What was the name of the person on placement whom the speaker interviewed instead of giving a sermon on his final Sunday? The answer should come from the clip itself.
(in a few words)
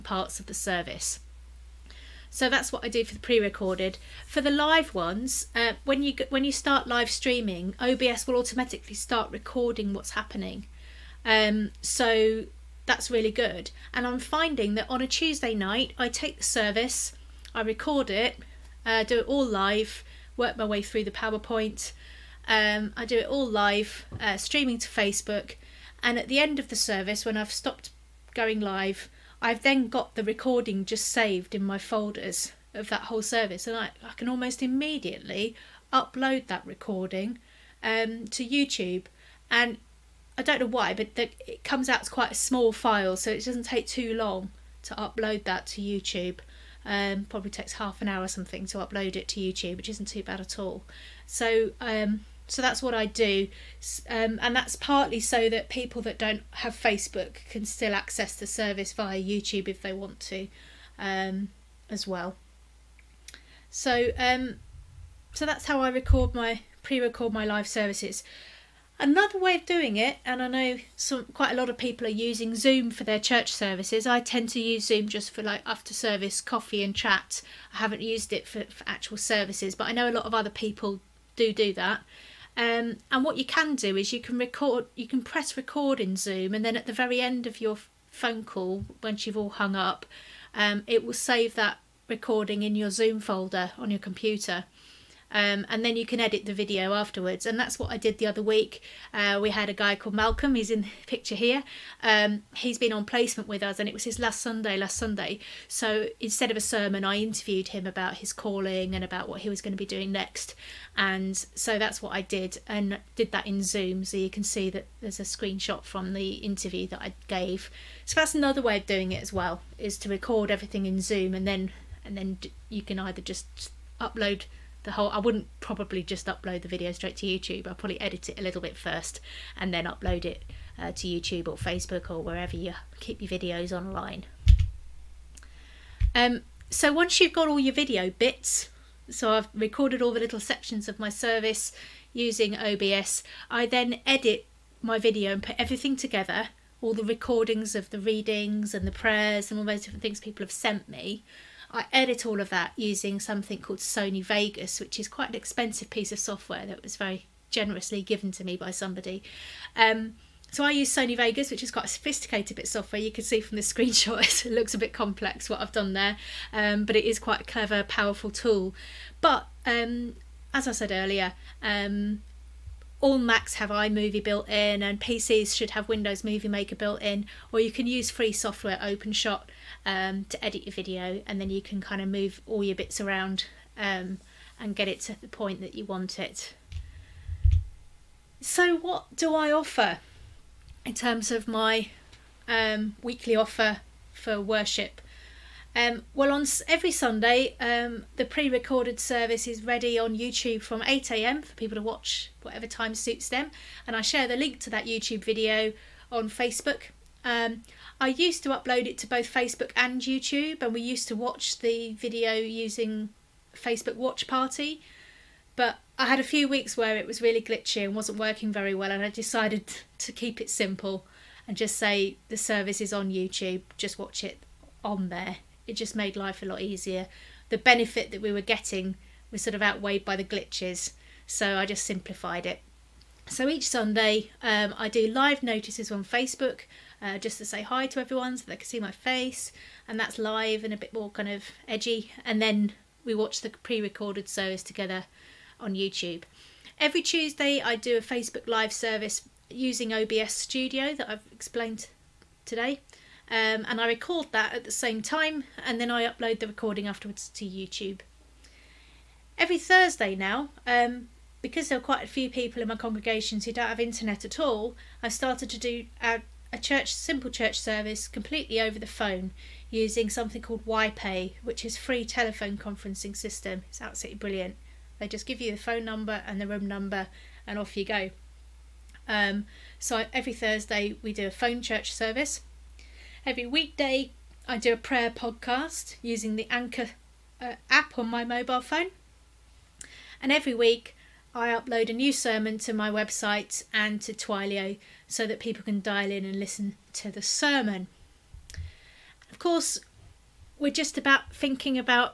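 Malcolm.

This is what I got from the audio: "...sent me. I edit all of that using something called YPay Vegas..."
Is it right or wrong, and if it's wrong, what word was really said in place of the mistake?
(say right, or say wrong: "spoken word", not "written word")
wrong: "Sony", not "YPay".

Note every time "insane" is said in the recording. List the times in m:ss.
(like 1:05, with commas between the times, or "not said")
not said.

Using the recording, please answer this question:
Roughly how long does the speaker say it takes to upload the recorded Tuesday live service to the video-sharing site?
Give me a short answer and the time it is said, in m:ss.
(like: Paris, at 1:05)
half an hour, at 0:47.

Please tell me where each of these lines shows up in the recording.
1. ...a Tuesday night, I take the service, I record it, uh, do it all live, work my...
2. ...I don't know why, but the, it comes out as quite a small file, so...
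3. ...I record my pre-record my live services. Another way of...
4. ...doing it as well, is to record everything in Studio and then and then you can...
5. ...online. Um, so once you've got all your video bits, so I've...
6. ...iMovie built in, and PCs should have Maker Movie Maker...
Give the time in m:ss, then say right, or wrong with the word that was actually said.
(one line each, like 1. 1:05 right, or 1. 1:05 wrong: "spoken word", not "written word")
1. 0:15 right
2. 0:40 right
3. 1:05 right
4. 1:58 wrong: "Zoom", not "Studio"
5. 2:13 right
6. 2:53 wrong: "Windows", not "Maker".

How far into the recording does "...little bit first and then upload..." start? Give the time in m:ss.
2:08.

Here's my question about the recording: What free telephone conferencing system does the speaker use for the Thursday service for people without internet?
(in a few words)
YPay.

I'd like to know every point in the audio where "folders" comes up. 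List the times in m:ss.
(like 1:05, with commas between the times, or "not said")
0:31, 1:33.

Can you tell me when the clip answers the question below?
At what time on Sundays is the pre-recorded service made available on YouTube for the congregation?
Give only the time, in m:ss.
3:20.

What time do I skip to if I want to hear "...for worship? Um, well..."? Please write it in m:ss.
3:14.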